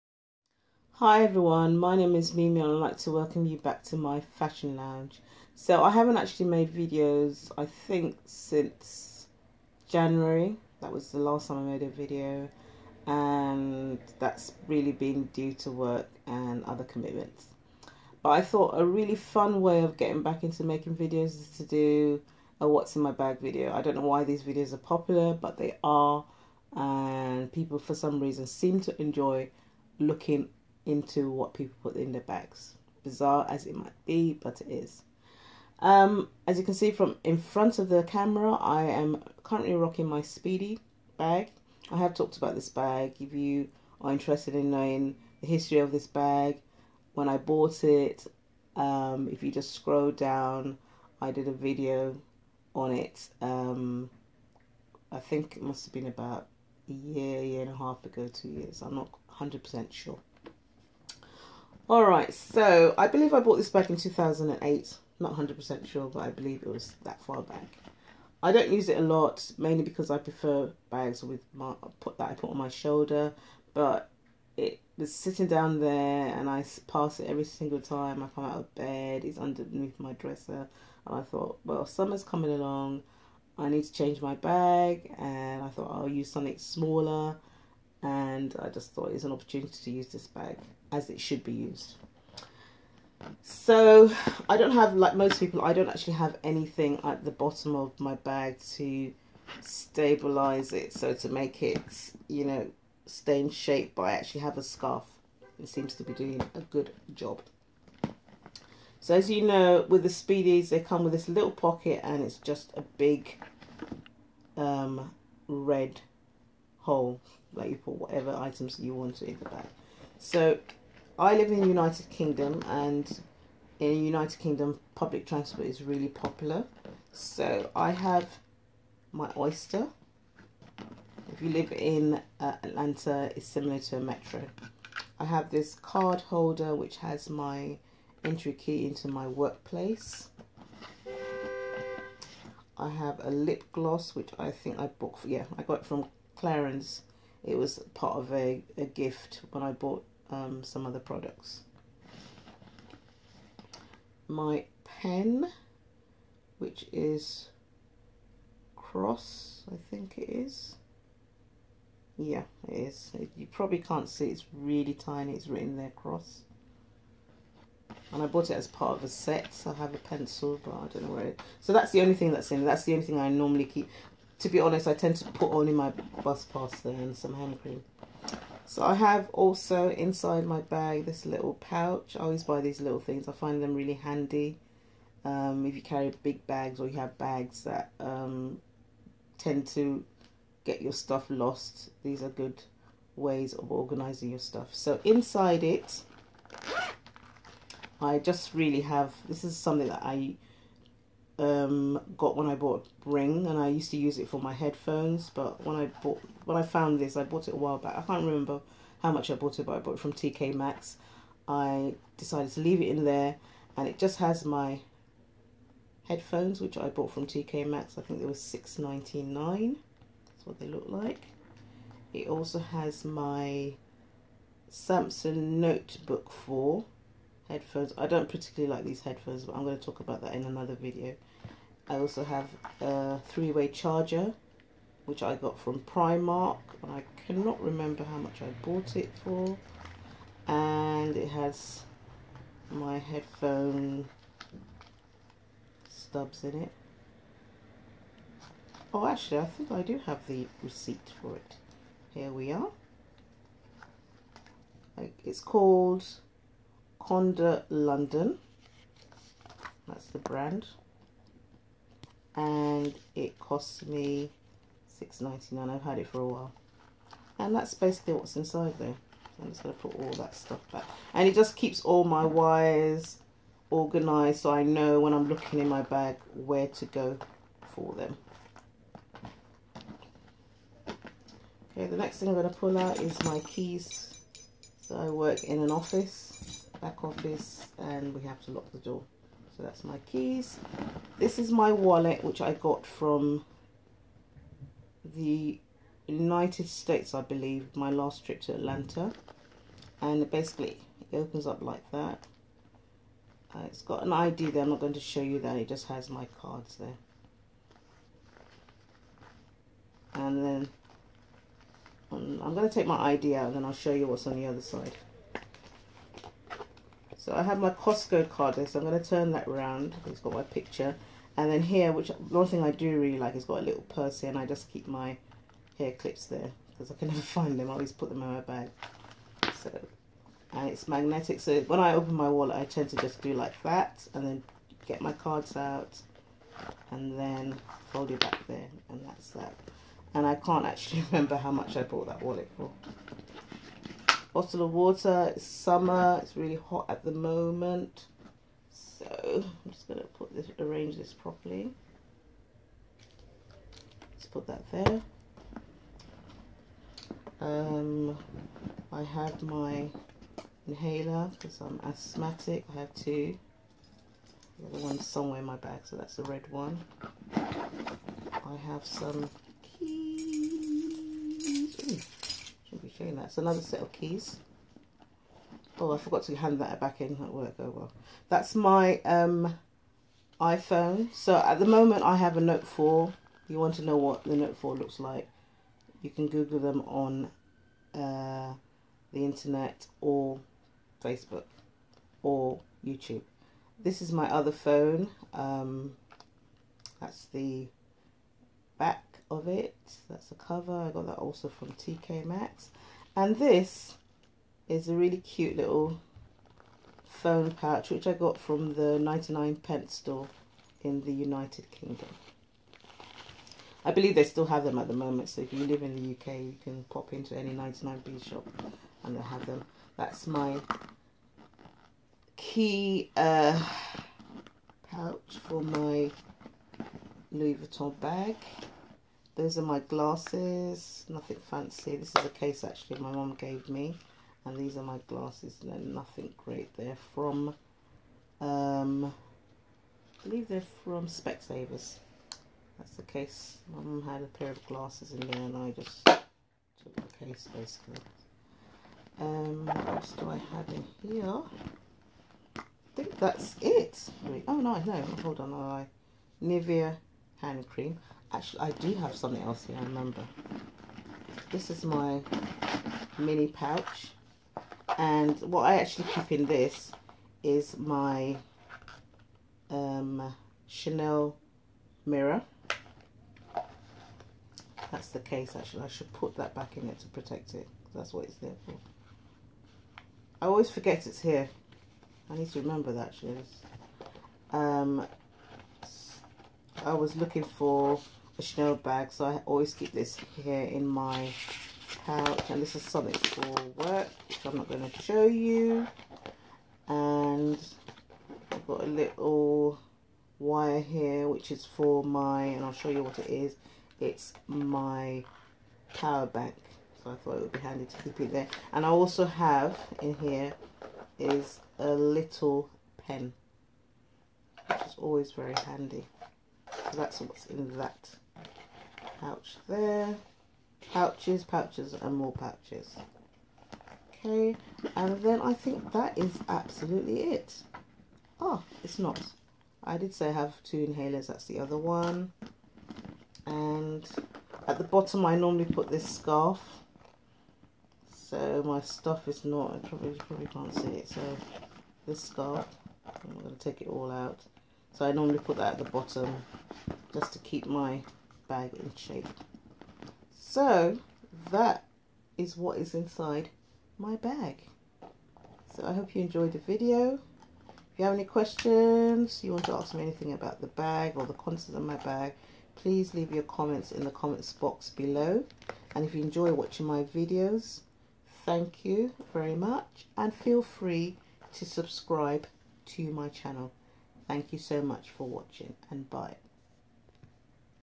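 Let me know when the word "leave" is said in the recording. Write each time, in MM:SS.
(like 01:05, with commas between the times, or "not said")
03:32, 09:23.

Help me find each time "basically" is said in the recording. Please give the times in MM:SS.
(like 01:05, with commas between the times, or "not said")
04:27, 05:00, 07:27.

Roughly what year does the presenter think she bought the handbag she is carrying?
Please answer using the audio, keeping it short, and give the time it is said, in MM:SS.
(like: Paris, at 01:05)
2008, at 01:03.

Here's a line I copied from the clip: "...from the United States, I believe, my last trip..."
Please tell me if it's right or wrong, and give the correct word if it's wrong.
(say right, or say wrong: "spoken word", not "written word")
right.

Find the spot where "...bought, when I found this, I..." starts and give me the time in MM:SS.
03:26.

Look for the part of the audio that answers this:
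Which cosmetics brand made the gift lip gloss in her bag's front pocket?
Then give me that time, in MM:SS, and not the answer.
02:26.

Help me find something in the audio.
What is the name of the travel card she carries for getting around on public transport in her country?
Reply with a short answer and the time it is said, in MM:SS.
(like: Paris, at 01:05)
Oyster, at 02:09.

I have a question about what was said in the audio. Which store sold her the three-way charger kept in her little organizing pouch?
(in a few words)
Primark.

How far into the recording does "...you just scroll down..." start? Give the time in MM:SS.
00:49.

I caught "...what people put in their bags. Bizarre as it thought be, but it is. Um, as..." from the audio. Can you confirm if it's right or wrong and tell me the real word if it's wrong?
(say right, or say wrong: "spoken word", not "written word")
wrong: "might", not "thought".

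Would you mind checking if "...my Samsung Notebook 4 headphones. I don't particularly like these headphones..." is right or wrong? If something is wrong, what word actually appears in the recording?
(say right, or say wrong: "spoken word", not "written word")
right.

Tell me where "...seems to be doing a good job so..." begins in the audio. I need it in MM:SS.
01:45.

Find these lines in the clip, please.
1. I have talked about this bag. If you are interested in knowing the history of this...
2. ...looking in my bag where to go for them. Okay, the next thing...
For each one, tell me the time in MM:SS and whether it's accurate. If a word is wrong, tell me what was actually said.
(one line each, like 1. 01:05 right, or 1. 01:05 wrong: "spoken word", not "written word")
1. 00:41 right
2. 04:35 right.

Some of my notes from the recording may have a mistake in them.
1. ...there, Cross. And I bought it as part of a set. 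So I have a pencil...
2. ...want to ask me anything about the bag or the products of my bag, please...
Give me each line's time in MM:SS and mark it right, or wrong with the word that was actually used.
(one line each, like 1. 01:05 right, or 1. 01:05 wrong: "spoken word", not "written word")
1. 02:45 right
2. 09:19 wrong: "contents", not "products".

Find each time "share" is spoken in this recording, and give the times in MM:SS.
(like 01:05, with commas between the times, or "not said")
not said.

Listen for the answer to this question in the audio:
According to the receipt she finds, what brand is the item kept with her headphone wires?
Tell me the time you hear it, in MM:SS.
04:17.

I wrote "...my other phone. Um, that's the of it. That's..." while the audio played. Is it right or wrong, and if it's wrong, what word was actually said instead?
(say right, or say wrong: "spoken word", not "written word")
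right.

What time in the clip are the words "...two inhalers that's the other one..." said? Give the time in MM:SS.
08:50.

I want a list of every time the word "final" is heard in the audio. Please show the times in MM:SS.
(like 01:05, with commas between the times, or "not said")
not said.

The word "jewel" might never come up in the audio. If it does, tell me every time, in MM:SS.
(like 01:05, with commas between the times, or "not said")
not said.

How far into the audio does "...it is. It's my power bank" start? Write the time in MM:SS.
08:23.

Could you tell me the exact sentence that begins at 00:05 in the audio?
So I haven't actually made videos I think since January.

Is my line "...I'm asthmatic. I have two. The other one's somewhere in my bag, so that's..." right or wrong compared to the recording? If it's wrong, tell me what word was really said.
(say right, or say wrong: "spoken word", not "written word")
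right.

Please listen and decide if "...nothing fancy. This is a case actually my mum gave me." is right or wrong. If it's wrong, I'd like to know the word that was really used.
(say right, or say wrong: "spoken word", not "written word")
right.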